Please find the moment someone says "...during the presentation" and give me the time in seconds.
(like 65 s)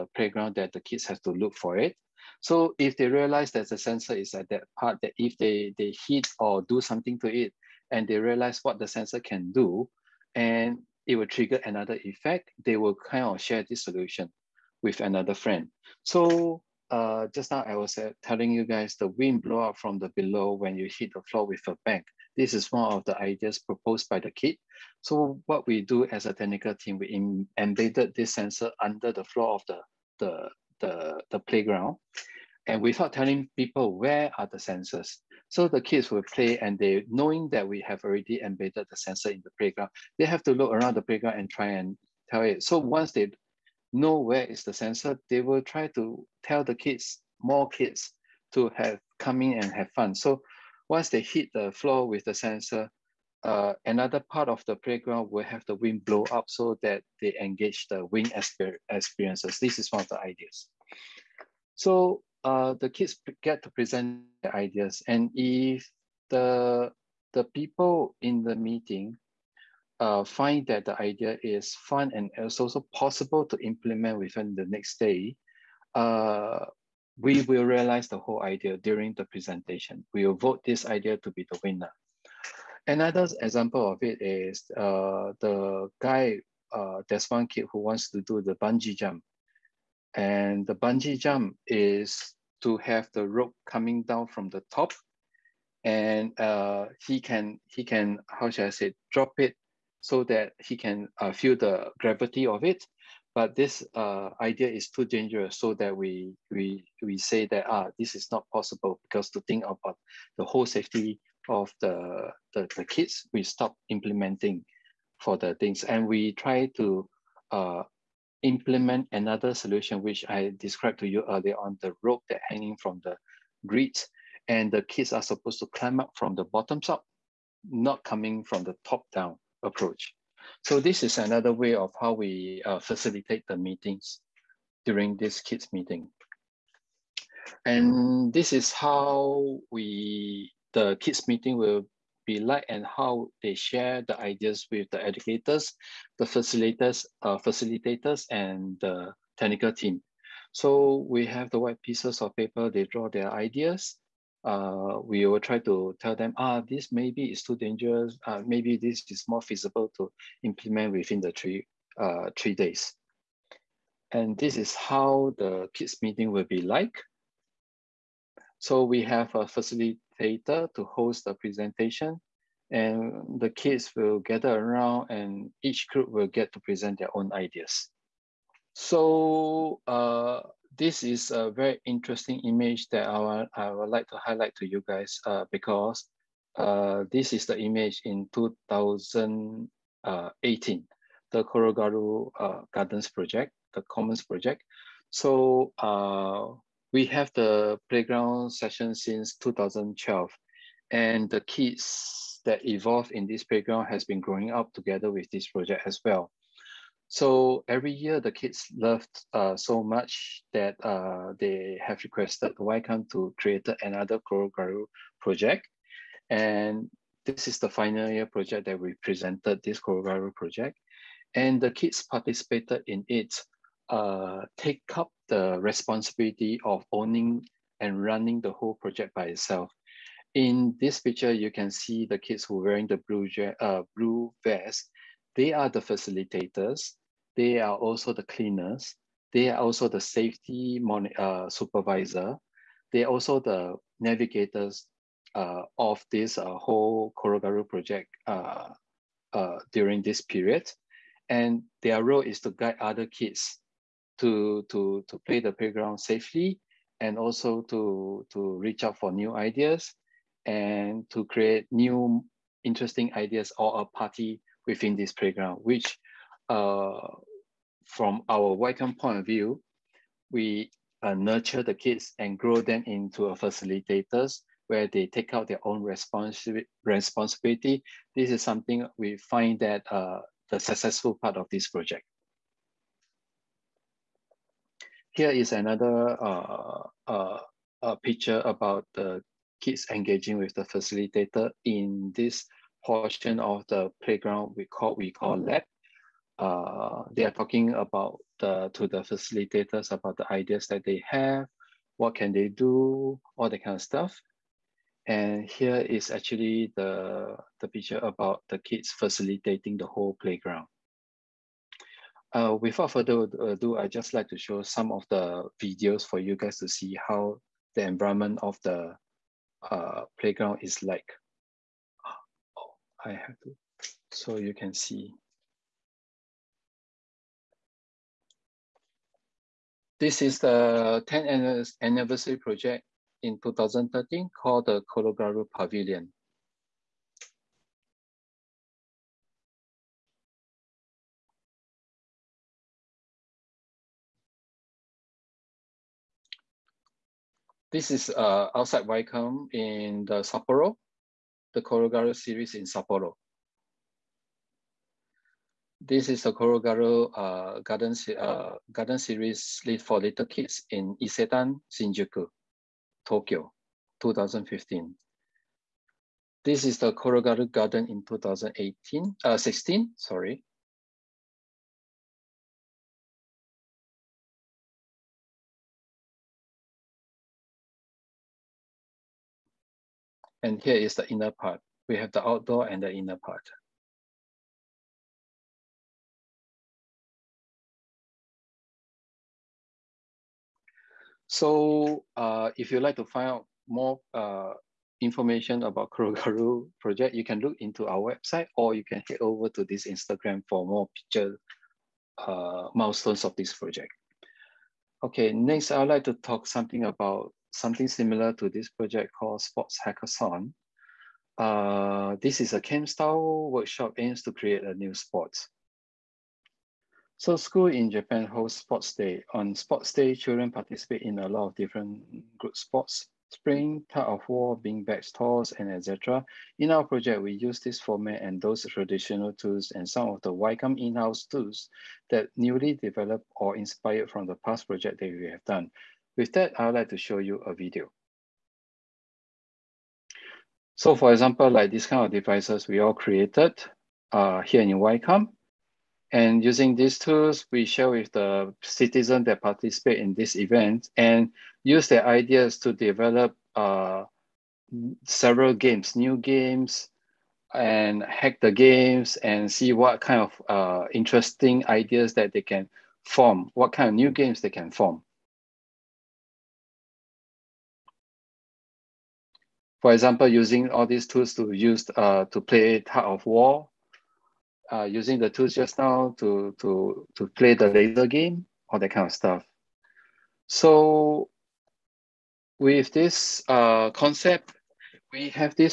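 78 s.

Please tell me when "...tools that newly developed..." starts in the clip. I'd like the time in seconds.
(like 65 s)
431 s.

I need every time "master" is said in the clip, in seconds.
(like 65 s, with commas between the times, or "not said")
not said.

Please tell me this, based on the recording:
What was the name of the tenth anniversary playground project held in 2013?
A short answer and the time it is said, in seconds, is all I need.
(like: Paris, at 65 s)
Korogaru Pavilion, at 334 s.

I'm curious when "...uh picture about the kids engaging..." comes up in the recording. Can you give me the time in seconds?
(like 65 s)
287 s.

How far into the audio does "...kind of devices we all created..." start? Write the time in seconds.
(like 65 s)
441 s.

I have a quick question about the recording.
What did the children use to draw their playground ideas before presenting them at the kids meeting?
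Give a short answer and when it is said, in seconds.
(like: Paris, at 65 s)
White pieces of paper, at 151 s.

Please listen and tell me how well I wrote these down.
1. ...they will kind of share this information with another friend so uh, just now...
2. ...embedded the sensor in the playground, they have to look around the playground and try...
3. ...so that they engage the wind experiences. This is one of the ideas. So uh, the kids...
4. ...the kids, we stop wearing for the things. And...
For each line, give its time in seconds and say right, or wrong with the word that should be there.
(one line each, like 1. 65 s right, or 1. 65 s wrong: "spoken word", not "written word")
1. 12 s wrong: "solution", not "information"
2. 38 s right
3. 56 s right
4. 112 s wrong: "implementing", not "wearing".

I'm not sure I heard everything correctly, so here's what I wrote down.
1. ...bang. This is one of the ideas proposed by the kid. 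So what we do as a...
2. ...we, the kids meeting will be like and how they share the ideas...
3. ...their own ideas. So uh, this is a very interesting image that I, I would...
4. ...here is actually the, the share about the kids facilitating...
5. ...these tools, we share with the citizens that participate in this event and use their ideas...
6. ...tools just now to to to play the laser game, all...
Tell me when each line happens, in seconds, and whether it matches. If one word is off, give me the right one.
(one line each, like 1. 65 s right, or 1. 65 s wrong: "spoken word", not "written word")
1. 21 s right
2. 139 s right
3. 177 s right
4. 305 s wrong: "picture", not "share"
5. 446 s right
6. 475 s right.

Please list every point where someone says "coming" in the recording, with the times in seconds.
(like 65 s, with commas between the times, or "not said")
93 s, 128 s.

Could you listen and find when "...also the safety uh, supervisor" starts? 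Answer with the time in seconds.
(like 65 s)
239 s.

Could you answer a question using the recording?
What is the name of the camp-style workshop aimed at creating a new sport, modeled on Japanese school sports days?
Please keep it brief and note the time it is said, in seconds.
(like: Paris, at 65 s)
Sports Hackathon, at 409 s.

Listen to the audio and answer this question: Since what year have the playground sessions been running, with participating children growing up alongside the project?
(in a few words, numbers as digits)
2012.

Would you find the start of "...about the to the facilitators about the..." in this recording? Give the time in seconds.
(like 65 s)
297 s.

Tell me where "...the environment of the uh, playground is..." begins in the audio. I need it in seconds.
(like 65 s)
317 s.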